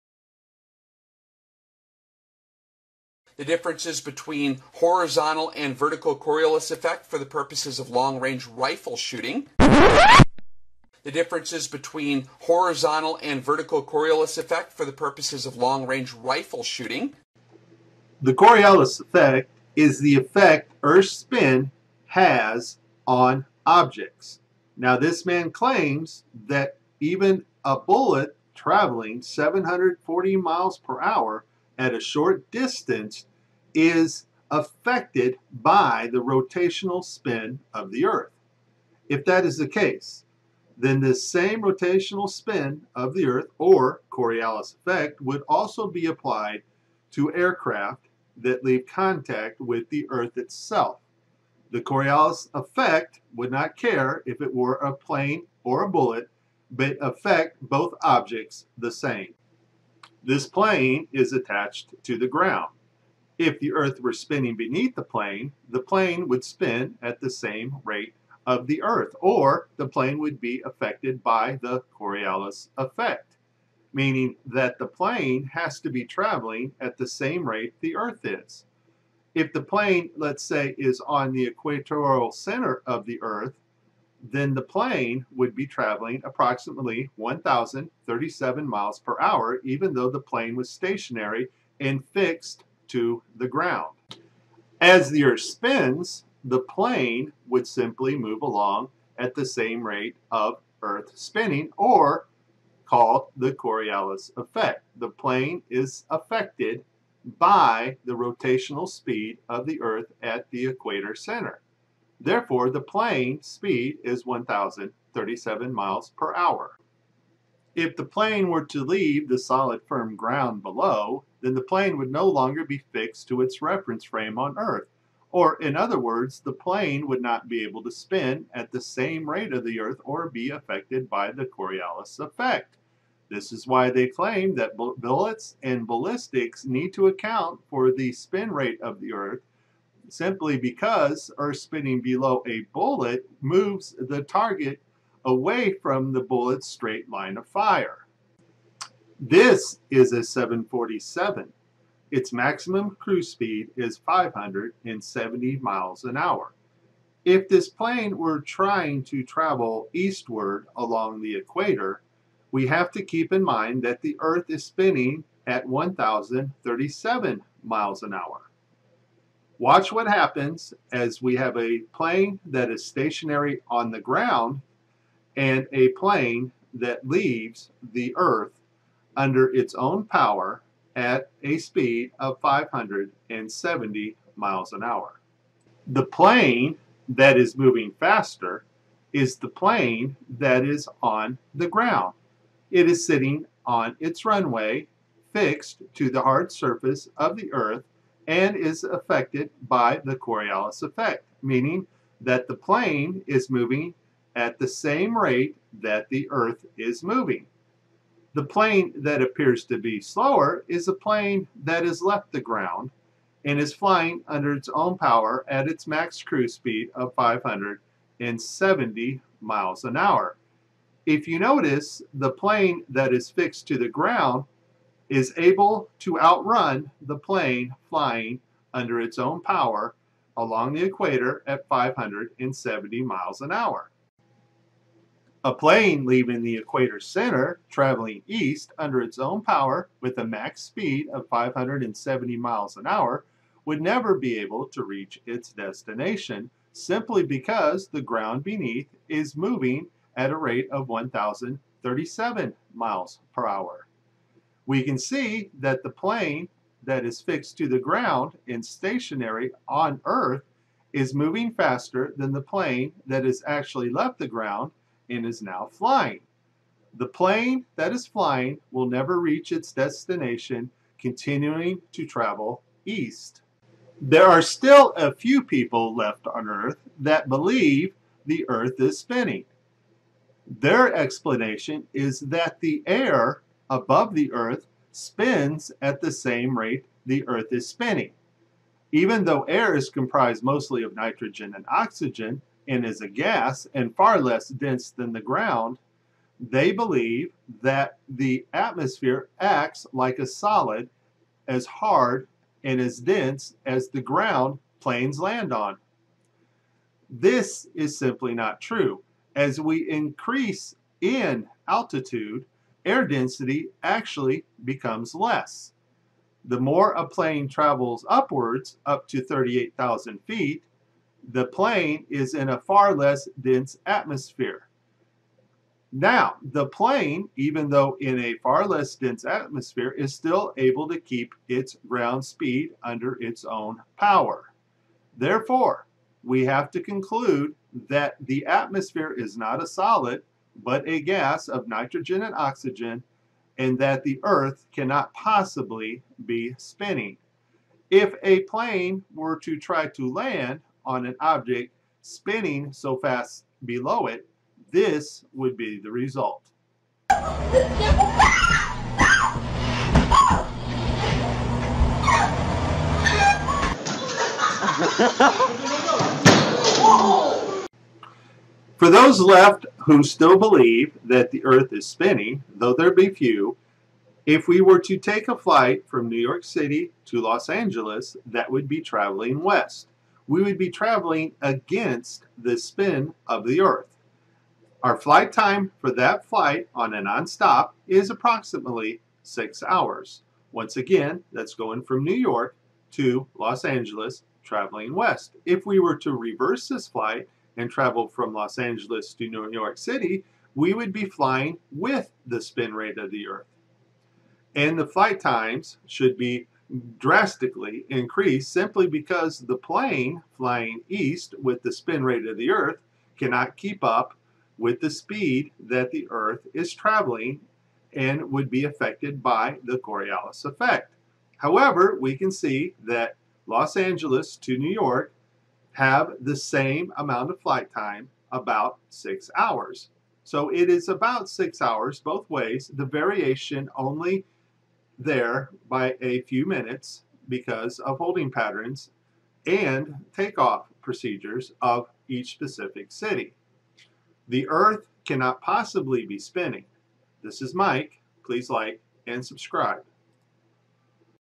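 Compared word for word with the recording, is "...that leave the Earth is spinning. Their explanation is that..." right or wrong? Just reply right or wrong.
wrong.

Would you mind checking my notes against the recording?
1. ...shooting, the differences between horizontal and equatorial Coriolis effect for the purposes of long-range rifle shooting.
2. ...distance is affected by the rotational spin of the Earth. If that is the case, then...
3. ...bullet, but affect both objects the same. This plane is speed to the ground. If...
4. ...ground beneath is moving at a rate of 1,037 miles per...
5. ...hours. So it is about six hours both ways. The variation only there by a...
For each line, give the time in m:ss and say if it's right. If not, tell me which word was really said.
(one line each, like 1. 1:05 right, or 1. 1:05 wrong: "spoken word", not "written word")
1. 0:08 wrong: "vertical", not "equatorial"
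2. 0:32 right
3. 0:55 wrong: "attached", not "speed"
4. 4:08 right
5. 7:09 right.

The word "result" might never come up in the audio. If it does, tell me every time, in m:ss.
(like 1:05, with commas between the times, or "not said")
5:55.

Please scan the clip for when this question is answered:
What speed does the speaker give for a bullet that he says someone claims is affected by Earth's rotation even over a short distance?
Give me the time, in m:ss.
0:29.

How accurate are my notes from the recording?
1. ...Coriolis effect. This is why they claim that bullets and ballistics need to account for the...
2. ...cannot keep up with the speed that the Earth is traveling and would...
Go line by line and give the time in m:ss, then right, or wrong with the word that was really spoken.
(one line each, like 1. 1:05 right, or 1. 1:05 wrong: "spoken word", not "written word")
1. 2:11 right
2. 6:53 right.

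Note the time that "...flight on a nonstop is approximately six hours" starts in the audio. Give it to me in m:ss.
6:26.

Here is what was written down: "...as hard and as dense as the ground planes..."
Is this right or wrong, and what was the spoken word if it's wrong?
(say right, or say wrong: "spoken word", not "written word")
right.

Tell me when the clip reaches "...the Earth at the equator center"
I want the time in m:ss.
1:49.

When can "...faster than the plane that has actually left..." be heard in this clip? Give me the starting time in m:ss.
4:21.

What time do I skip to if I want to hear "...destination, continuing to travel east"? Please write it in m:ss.
4:29.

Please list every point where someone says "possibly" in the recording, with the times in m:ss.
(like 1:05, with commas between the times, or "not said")
5:45, 7:25.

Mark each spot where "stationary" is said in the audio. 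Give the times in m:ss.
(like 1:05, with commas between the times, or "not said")
1:30, 2:52, 4:18.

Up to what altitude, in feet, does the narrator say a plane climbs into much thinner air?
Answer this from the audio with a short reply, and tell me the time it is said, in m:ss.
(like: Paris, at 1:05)
38,000 feet, at 5:19.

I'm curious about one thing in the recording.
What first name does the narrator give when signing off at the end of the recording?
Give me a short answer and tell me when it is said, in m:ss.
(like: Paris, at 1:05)
Mike, at 7:27.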